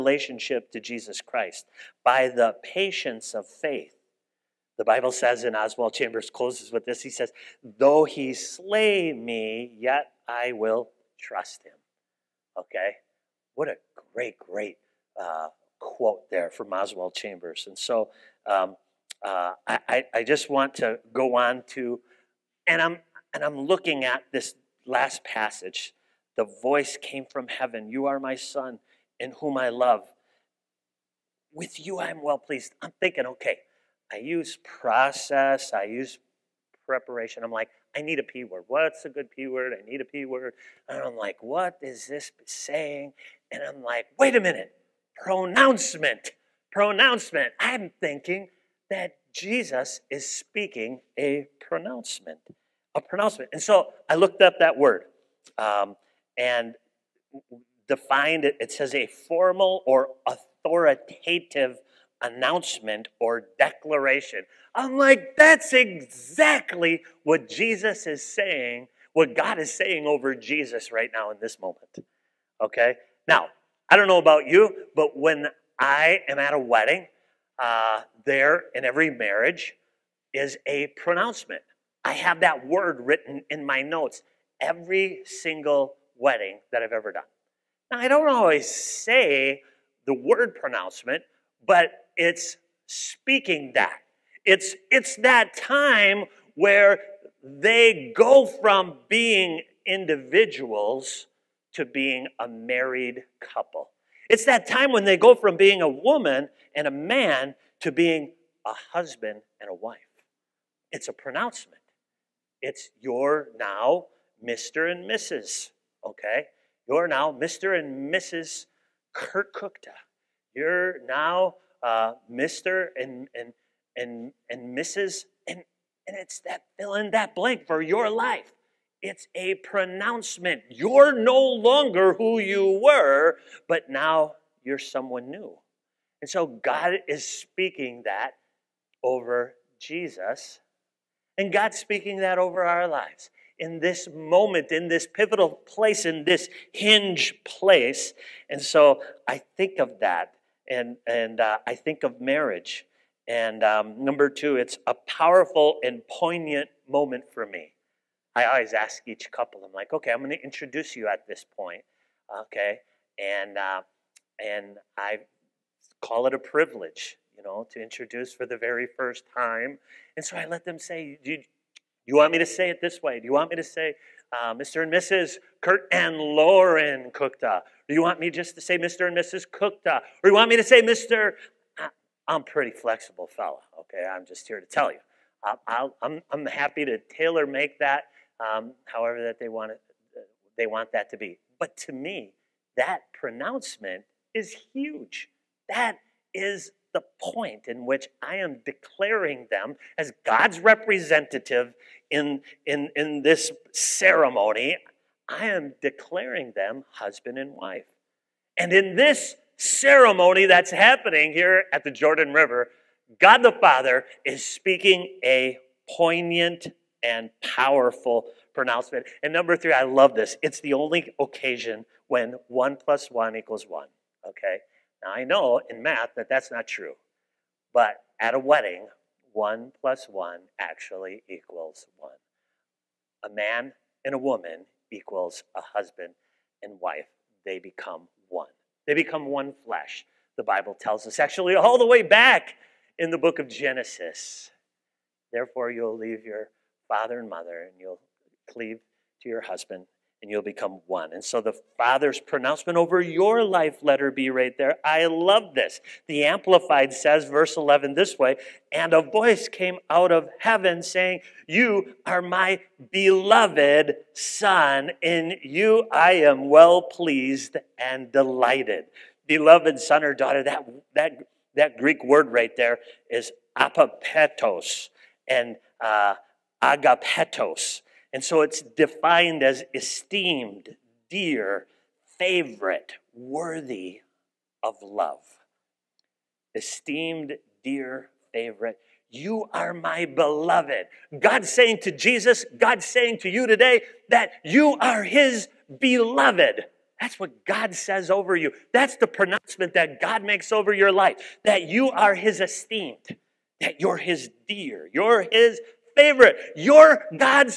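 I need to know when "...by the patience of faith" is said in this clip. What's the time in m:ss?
0:02.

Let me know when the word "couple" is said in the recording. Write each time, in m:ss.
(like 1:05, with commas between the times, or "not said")
1:43, 2:39.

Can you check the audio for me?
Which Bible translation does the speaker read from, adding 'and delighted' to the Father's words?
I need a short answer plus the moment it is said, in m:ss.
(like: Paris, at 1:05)
Amplified, at 4:16.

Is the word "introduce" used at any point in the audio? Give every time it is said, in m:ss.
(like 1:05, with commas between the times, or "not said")
2:40, 2:47.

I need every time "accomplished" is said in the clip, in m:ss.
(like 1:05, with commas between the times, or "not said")
not said.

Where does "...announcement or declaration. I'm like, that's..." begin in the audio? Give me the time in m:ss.
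1:02.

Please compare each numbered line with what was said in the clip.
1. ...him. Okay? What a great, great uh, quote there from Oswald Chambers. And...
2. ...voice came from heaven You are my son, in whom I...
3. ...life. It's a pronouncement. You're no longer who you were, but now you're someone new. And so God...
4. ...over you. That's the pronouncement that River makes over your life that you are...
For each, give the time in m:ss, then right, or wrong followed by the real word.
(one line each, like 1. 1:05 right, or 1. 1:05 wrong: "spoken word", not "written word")
1. 0:11 right
2. 0:26 right
3. 2:08 right
4. 4:58 wrong: "God", not "River".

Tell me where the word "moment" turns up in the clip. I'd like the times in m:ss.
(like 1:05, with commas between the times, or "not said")
1:11, 2:24, 2:36.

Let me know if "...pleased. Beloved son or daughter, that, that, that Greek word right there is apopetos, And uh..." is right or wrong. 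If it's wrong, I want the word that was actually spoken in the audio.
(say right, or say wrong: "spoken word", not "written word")
wrong: "delighted", not "pleased".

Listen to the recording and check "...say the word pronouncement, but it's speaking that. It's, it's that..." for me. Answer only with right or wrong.
right.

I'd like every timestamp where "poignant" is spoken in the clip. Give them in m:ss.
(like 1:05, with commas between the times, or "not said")
2:36, 3:35.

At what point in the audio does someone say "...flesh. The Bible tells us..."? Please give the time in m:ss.
3:59.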